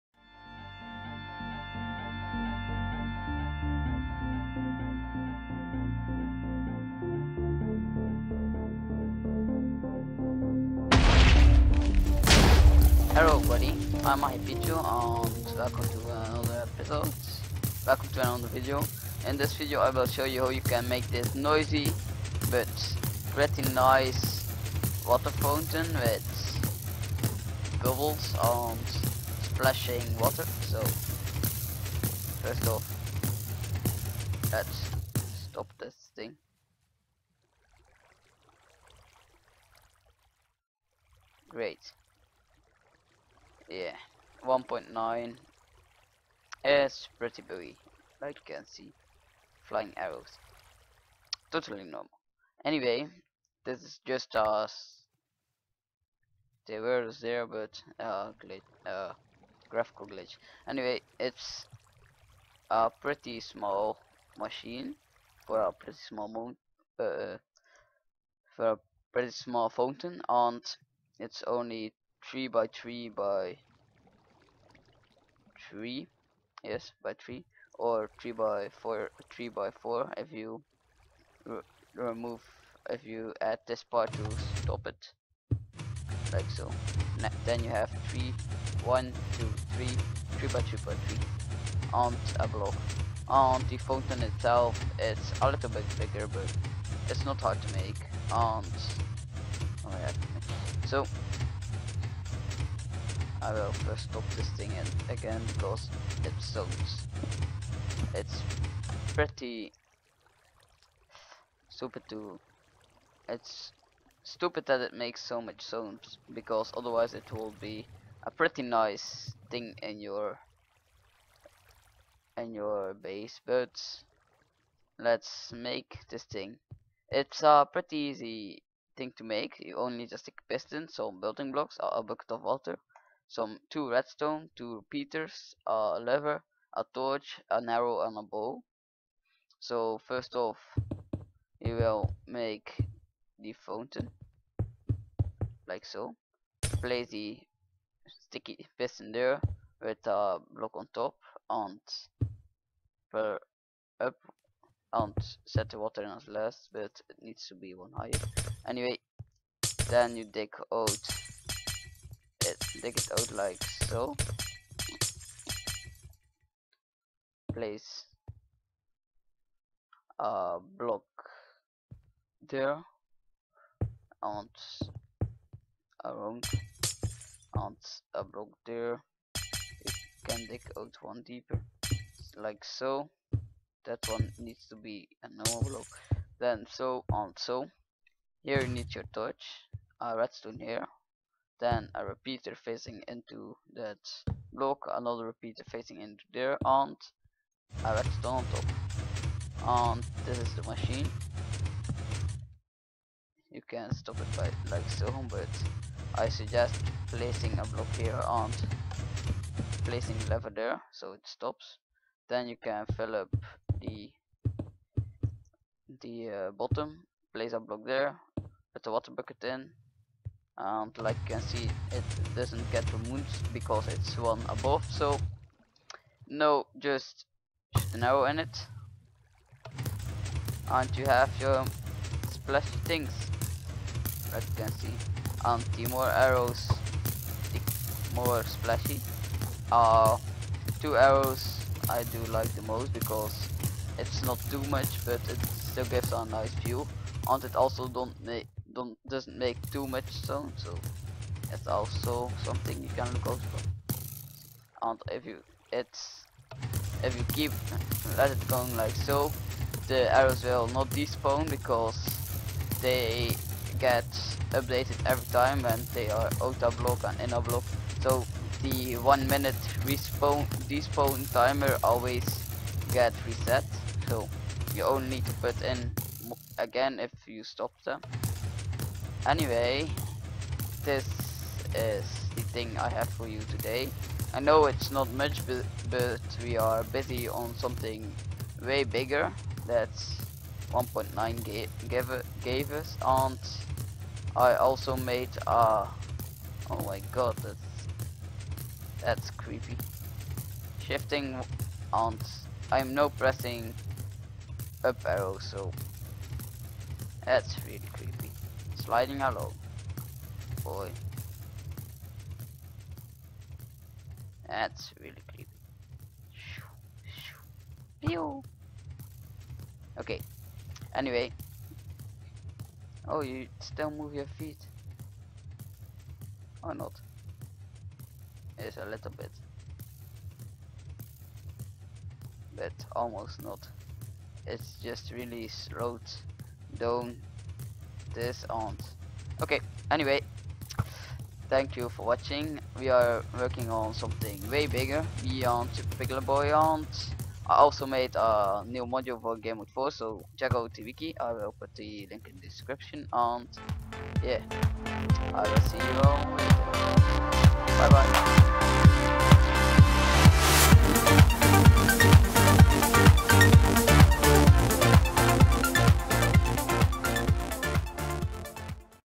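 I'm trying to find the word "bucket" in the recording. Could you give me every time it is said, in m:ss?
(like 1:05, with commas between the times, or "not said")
2:12, 3:39.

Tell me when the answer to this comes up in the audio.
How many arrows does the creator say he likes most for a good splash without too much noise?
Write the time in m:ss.
4:00.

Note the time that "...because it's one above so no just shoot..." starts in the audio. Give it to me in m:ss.
3:43.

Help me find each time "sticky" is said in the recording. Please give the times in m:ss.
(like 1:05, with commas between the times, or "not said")
2:28.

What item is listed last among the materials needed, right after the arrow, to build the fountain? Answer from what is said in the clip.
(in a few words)
a bow.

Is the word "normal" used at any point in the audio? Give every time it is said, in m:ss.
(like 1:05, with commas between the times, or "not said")
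0:51, 3:05.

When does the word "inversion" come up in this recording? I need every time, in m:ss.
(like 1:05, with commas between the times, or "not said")
not said.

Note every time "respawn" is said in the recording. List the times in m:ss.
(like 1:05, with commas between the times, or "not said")
4:29.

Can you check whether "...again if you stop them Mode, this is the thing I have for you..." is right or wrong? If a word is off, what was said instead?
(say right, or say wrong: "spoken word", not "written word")
wrong: "Anyway", not "Mode".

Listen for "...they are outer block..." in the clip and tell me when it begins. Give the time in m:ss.
4:25.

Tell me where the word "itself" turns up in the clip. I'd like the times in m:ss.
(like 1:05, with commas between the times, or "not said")
1:34.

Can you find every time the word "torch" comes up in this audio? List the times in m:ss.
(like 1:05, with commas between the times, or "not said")
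2:16, 3:09.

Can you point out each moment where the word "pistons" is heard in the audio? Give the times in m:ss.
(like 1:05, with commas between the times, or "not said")
2:10, 2:28.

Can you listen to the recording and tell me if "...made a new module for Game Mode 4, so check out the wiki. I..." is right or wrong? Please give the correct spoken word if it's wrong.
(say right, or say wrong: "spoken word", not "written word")
right.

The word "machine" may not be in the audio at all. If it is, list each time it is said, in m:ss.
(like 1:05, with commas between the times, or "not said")
1:04, 3:20.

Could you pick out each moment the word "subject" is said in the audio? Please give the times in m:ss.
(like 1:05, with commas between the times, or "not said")
not said.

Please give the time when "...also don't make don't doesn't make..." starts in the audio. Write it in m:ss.
4:07.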